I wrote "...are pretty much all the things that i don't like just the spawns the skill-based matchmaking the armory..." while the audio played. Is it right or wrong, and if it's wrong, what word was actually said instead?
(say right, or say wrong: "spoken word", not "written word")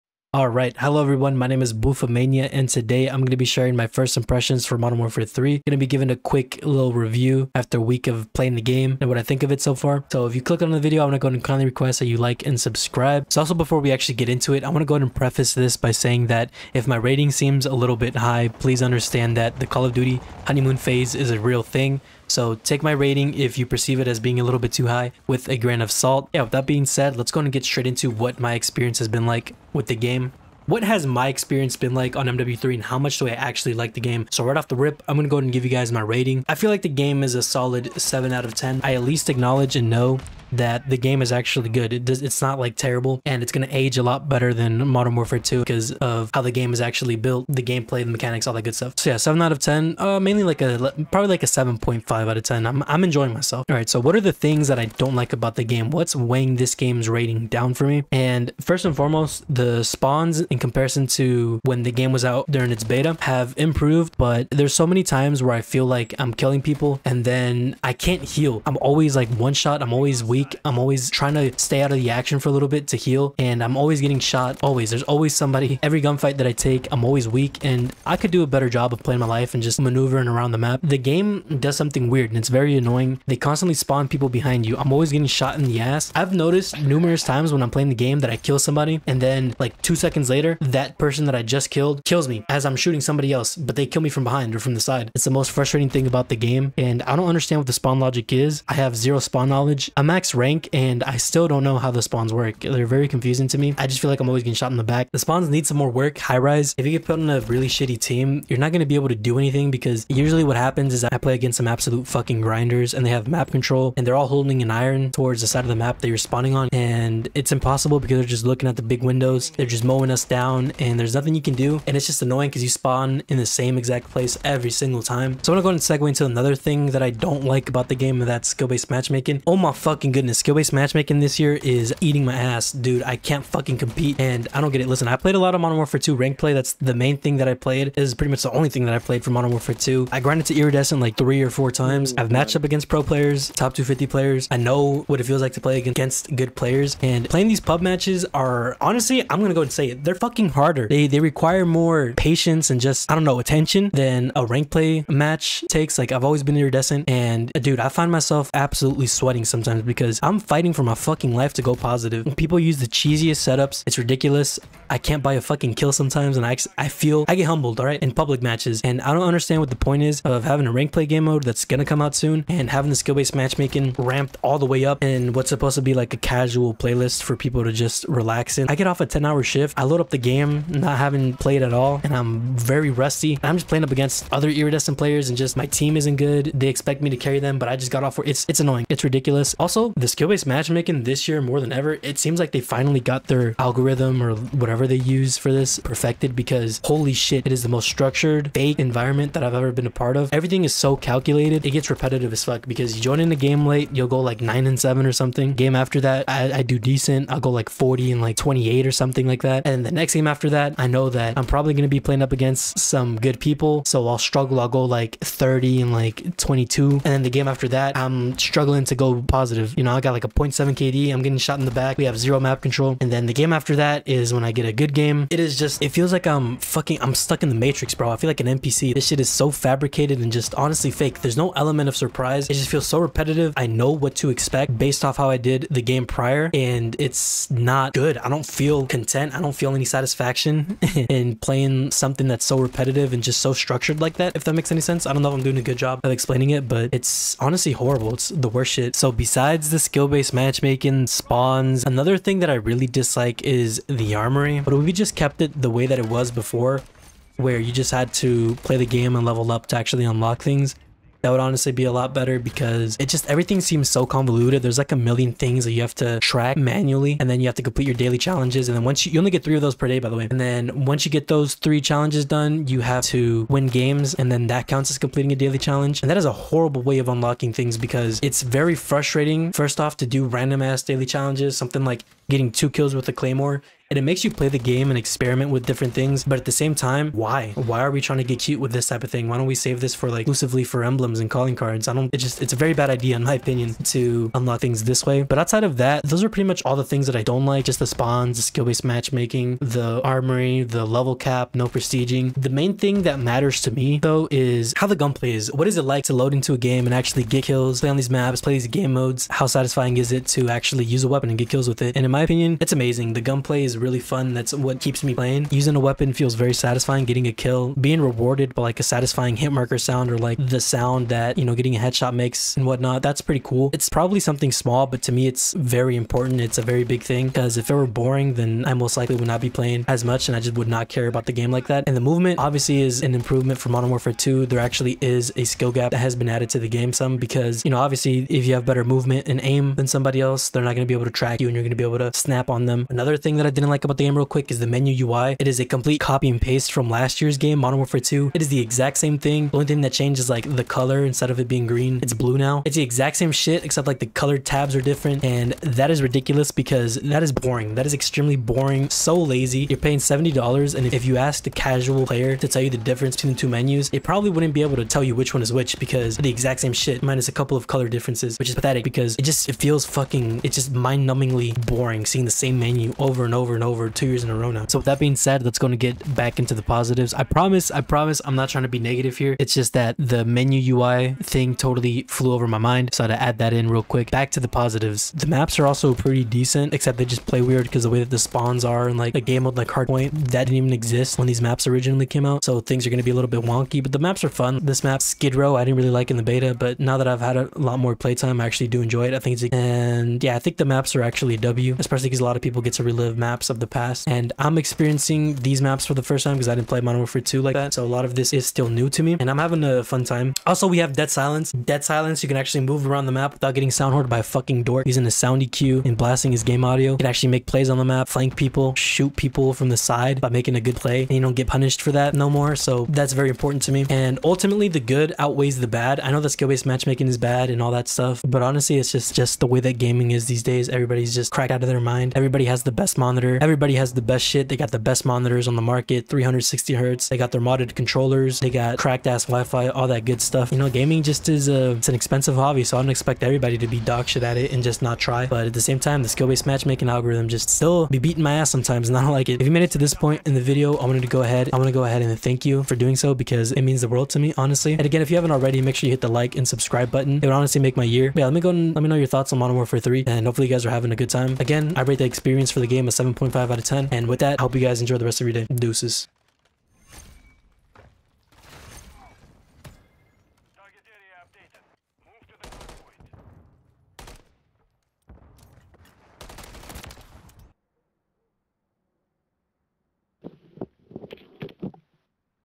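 right.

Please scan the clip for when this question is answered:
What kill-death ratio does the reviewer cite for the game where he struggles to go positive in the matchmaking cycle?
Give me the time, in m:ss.
3:40.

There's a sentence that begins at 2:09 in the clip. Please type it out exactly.
Oh my fucking good goodness, skill-based matchmaking this year is eating my ass.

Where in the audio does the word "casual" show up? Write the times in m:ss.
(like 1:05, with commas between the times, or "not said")
2:56, 6:01.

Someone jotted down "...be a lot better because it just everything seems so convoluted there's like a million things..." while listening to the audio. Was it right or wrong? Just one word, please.
right.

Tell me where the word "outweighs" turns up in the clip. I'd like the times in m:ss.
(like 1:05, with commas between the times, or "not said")
7:05.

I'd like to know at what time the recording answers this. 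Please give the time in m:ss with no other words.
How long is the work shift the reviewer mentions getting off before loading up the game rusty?
2:59.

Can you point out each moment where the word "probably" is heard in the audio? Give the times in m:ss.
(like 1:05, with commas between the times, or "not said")
0:51, 3:31, 5:23, 6:04.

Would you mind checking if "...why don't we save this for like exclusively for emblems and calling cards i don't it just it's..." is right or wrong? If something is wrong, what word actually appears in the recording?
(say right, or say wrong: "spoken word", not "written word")
right.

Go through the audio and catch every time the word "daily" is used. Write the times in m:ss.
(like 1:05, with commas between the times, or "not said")
4:27, 4:35, 4:40.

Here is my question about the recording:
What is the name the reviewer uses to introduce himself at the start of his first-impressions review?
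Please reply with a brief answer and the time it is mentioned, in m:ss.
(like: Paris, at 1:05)
Boofamania, at 0:01.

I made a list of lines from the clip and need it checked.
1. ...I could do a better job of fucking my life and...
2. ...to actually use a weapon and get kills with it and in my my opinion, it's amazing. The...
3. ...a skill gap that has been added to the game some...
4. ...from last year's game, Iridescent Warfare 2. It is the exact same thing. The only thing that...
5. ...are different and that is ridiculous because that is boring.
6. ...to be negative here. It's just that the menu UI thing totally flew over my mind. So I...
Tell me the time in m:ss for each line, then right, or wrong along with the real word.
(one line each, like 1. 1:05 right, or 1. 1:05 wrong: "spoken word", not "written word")
1. 1:18 wrong: "playing", not "fucking"
2. 5:10 right
3. 5:35 right
4. 5:46 wrong: "Modern", not "Iridescent"
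5. 5:54 right
6. 6:18 right.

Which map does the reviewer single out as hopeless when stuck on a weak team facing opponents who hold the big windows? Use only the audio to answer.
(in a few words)
Highrise.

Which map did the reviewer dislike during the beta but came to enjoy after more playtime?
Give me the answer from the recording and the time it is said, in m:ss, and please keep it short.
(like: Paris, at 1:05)
Skid Row, at 6:35.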